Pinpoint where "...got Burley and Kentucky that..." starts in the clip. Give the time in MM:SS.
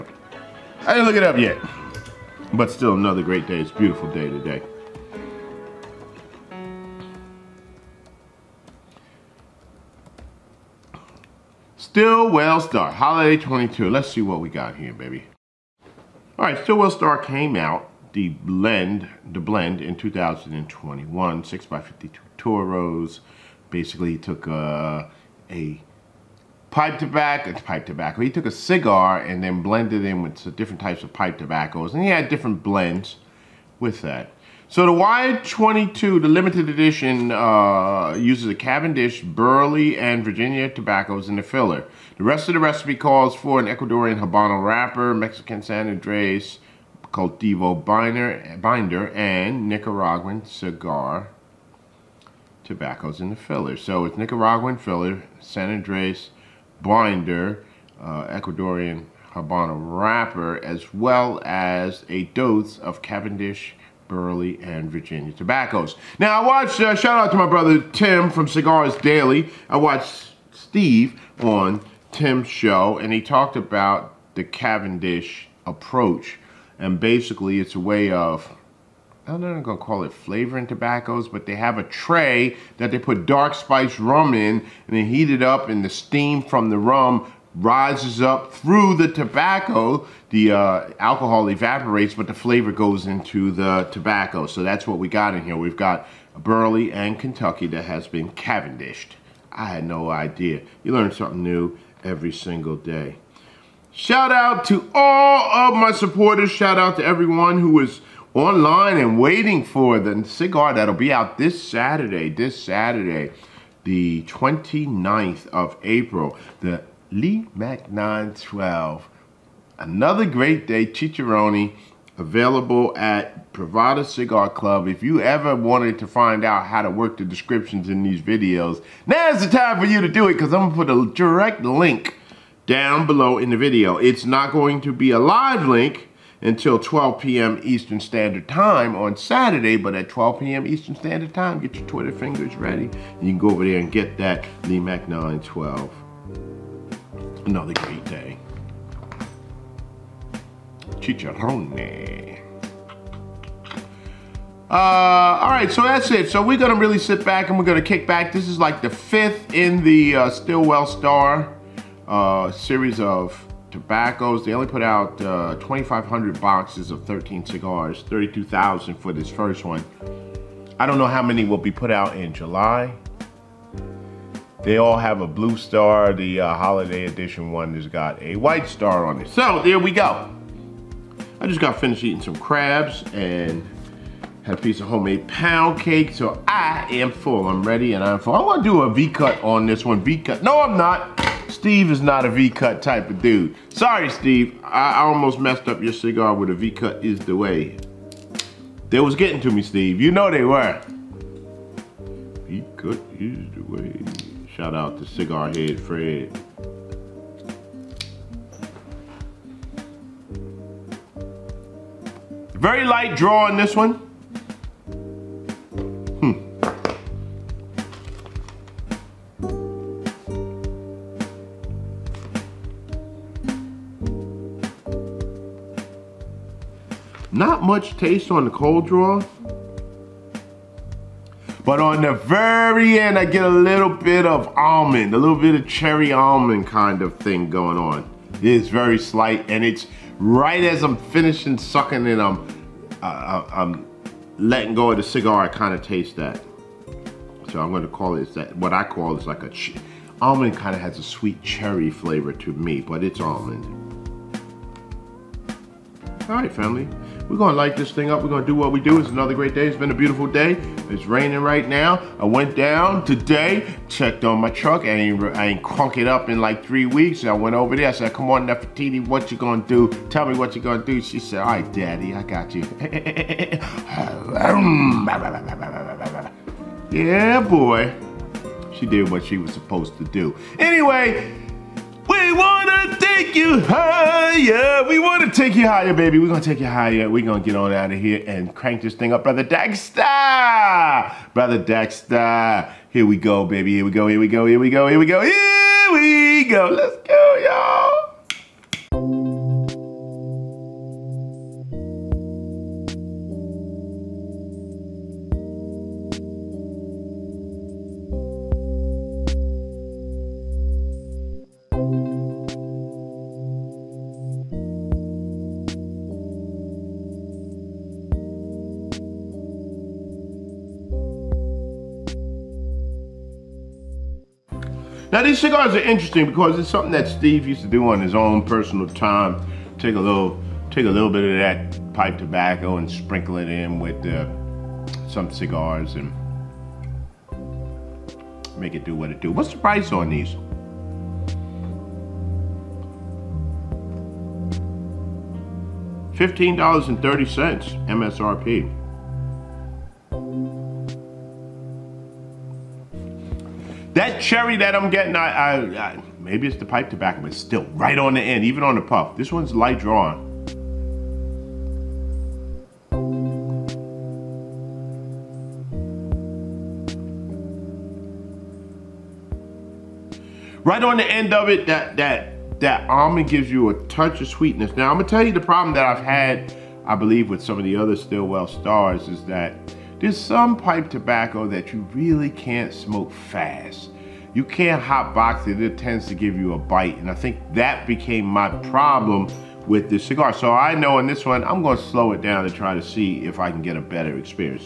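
01:35.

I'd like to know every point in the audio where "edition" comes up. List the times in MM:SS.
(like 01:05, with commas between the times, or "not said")
00:36, 02:57.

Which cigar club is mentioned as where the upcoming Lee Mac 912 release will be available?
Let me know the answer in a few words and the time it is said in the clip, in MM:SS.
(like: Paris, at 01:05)
Privada Cigar Club, at 02:03.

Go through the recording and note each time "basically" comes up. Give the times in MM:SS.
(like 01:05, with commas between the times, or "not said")
00:23, 01:16.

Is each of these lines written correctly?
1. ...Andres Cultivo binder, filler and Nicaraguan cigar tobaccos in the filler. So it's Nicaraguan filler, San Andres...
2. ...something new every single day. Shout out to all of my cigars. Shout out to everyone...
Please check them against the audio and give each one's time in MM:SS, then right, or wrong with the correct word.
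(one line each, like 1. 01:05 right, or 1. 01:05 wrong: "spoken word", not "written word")
1. 00:45 wrong: "binder", not "filler"
2. 01:41 wrong: "supporters", not "cigars".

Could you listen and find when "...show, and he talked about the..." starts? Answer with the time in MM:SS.
01:12.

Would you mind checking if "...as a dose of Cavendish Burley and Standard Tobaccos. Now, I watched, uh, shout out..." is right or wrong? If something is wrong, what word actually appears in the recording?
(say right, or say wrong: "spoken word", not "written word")
wrong: "Virginia", not "Standard".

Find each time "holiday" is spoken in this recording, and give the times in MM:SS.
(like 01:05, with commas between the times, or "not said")
00:12, 02:56.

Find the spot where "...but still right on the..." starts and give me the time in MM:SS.
05:57.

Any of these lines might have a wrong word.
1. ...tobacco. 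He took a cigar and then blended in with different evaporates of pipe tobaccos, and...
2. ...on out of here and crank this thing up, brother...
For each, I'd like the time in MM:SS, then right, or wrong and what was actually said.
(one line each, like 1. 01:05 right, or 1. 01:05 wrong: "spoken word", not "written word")
1. 00:27 wrong: "types", not "evaporates"
2. 04:47 right.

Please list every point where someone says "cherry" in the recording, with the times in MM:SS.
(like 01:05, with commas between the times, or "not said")
03:55, 04:11, 05:54.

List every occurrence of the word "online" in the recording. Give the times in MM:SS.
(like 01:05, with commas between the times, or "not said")
01:48.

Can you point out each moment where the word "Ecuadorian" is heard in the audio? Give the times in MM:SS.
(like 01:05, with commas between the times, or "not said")
00:43, 00:58.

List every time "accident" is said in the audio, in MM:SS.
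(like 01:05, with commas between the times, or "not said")
not said.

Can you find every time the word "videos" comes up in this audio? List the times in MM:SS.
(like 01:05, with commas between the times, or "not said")
02:08, 02:13.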